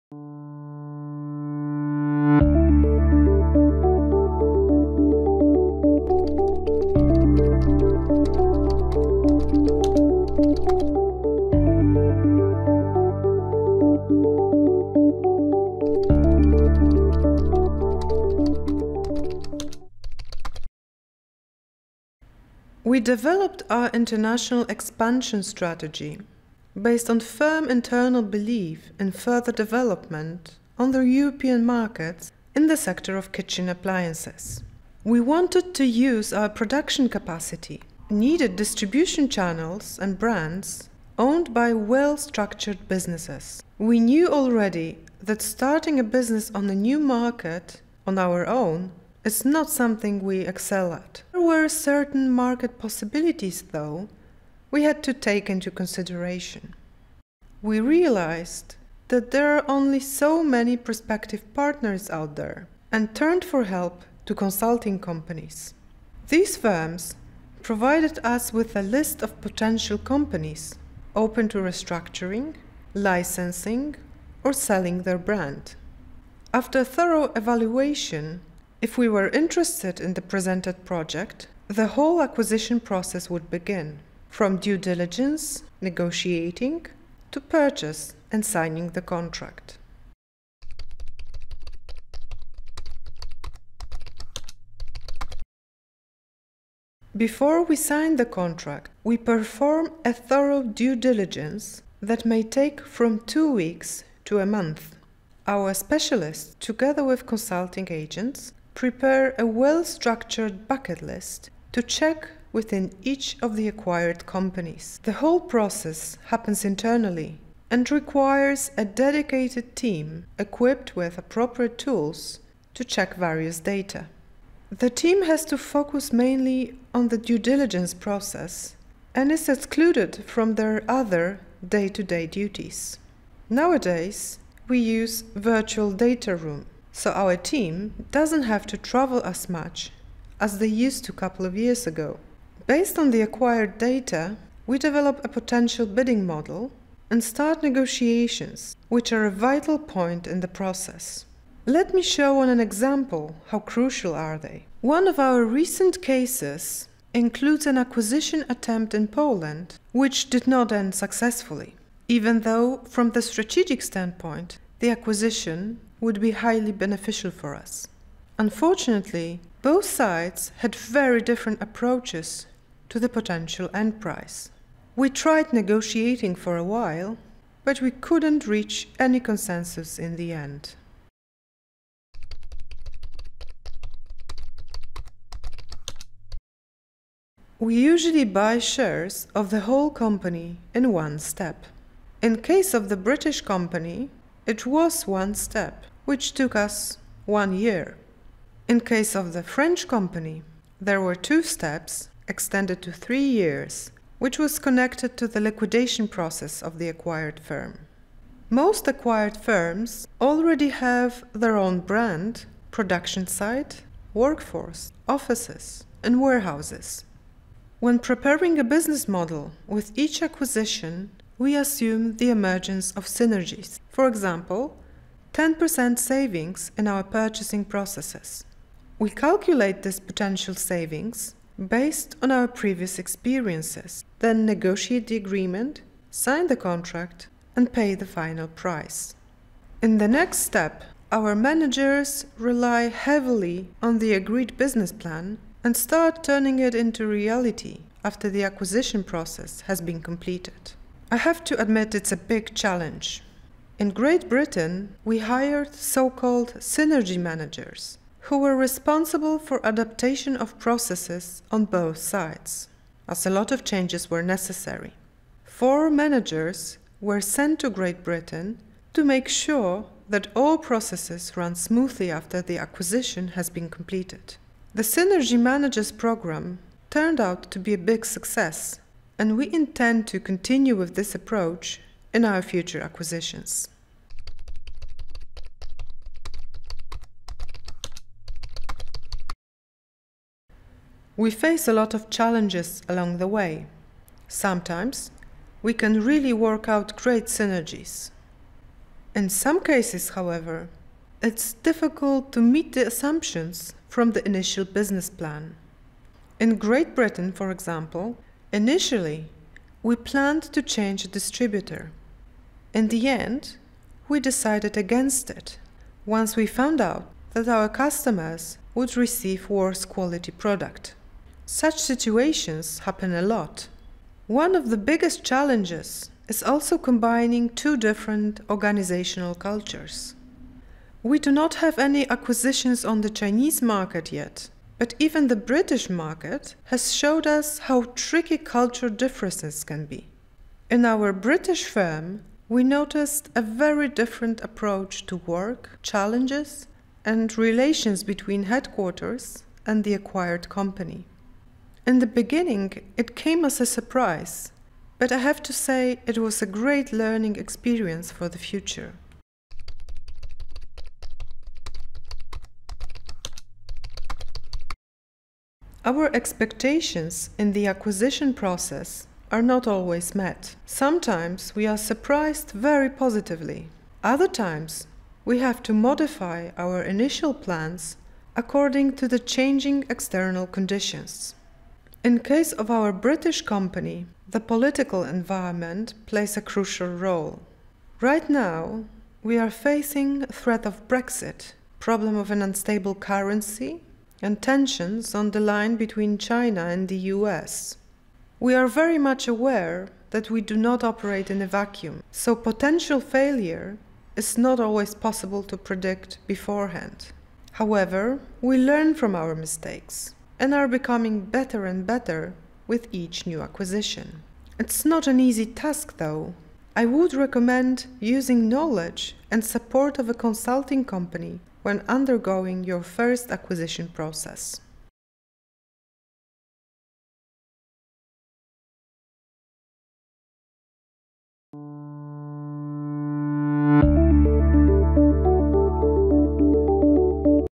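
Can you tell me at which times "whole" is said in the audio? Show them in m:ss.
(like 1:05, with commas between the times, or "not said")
1:21, 1:55, 3:09.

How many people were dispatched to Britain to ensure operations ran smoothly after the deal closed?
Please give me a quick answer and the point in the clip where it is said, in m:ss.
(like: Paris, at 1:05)
4, at 4:25.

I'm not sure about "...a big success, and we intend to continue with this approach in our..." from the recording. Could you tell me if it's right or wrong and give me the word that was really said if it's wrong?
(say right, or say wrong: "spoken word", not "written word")
right.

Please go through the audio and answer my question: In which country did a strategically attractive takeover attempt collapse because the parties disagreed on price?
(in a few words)
Poland.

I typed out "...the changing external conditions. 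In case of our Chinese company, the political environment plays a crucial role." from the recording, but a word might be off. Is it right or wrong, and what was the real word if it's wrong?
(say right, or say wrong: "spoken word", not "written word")
wrong: "British", not "Chinese".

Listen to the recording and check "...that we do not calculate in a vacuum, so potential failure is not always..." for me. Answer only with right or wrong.
wrong.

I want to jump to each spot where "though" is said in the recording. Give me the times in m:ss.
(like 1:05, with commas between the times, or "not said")
0:53, 2:42, 6:55.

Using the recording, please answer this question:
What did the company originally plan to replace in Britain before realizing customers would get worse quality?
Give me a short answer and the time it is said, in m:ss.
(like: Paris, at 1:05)
a distributor, at 5:11.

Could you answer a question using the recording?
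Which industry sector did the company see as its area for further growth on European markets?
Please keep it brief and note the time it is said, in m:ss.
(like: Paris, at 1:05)
kitchen appliances, at 0:33.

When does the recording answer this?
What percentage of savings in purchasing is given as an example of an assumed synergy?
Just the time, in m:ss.
3:45.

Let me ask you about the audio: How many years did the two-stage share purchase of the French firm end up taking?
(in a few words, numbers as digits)
3.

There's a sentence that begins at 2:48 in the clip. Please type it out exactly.
Unfortunately, both sides had very different approaches to the potential end price.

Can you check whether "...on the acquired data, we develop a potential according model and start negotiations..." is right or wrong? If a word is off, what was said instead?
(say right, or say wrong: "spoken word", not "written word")
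wrong: "bidding", not "according".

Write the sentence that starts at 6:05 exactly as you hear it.
Our expectations in the acquisition process are not always met.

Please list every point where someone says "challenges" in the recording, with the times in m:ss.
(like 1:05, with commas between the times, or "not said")
4:12, 4:52, 5:25, 5:45.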